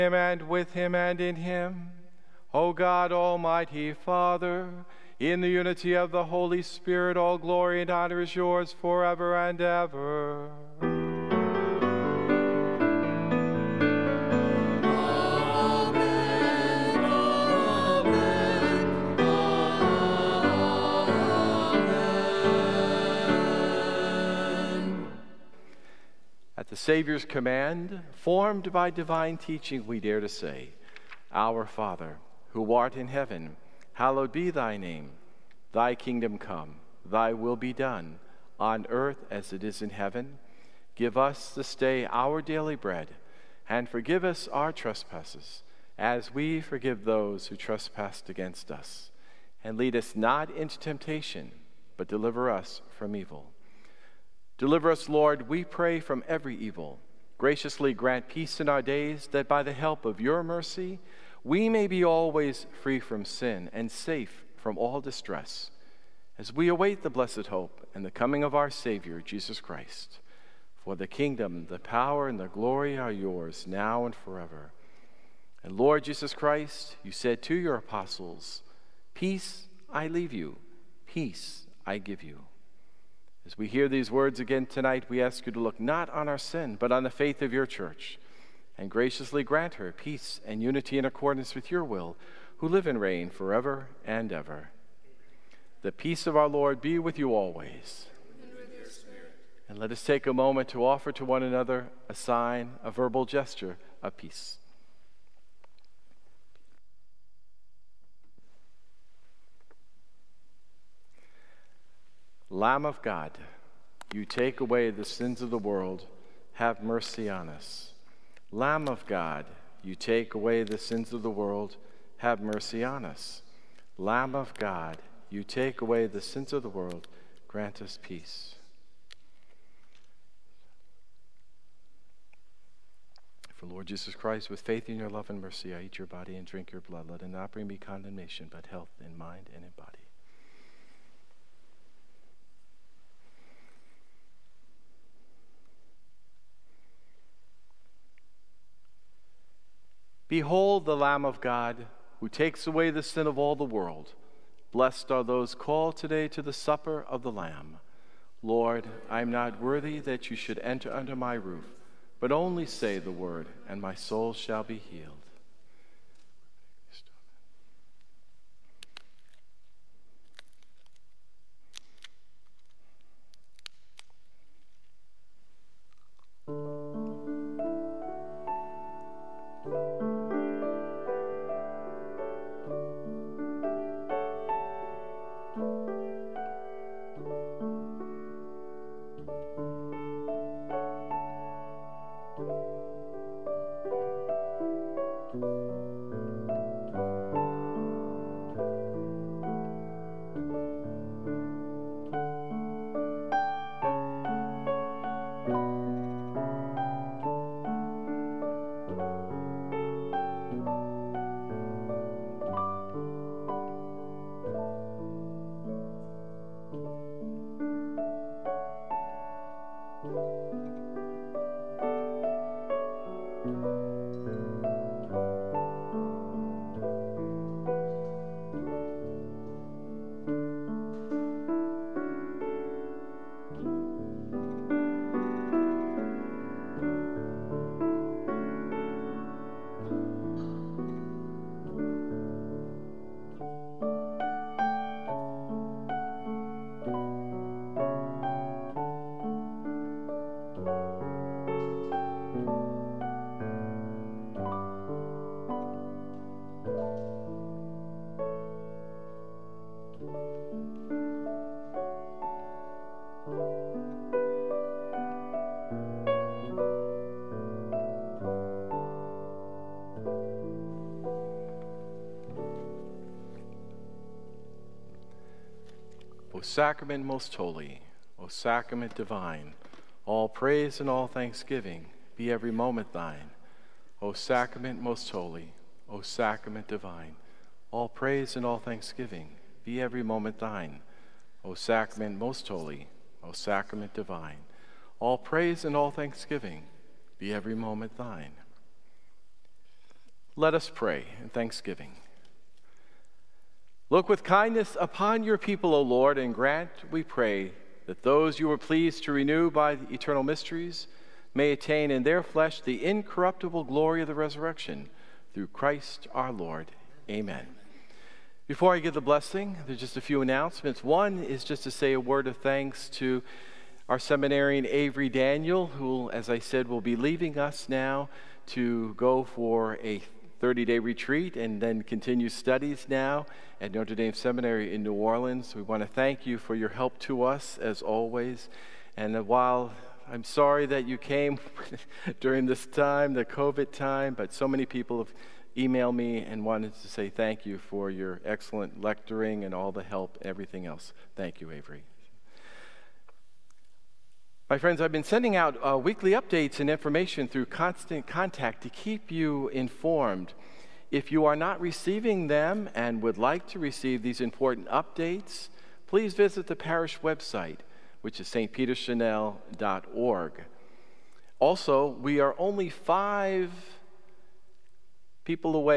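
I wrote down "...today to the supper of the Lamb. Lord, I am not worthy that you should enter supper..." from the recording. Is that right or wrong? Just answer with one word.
wrong.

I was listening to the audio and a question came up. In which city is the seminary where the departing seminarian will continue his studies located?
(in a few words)
New Orleans.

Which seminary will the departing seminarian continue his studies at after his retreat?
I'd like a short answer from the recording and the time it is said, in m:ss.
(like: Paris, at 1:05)
Notre Dame Seminary, at 5:33.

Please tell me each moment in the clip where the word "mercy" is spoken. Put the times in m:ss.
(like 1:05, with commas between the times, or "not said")
1:00, 1:56, 2:02, 2:15.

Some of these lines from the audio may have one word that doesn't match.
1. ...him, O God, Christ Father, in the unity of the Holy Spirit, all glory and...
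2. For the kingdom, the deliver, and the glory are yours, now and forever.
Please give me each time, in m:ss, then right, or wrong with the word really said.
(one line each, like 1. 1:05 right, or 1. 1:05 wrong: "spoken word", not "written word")
1. 0:01 wrong: "Almighty", not "Christ"
2. 1:10 wrong: "power", not "deliver".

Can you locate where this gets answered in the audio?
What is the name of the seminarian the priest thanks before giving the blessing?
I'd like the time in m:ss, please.
5:24.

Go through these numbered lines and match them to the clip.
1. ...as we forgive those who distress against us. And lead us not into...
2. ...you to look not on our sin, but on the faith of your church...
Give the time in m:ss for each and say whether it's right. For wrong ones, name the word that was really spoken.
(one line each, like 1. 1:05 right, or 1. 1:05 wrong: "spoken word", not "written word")
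1. 0:45 wrong: "trespass", not "distress"
2. 1:25 right.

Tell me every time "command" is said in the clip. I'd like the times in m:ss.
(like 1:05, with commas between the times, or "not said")
0:27.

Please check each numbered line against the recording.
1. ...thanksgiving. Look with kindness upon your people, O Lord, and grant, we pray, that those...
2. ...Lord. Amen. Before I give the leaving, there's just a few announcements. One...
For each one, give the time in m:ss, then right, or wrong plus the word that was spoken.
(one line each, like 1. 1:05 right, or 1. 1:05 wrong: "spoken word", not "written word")
1. 5:01 right
2. 5:16 wrong: "blessing", not "leaving".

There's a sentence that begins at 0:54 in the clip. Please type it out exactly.
Deliver us, Lord, we pray, from every evil.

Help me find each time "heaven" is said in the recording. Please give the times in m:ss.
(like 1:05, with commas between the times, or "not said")
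0:33, 0:39.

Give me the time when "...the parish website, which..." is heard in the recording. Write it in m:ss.
6:06.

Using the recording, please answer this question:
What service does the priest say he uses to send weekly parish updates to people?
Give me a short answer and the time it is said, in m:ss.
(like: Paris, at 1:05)
Constant Contact, at 5:57.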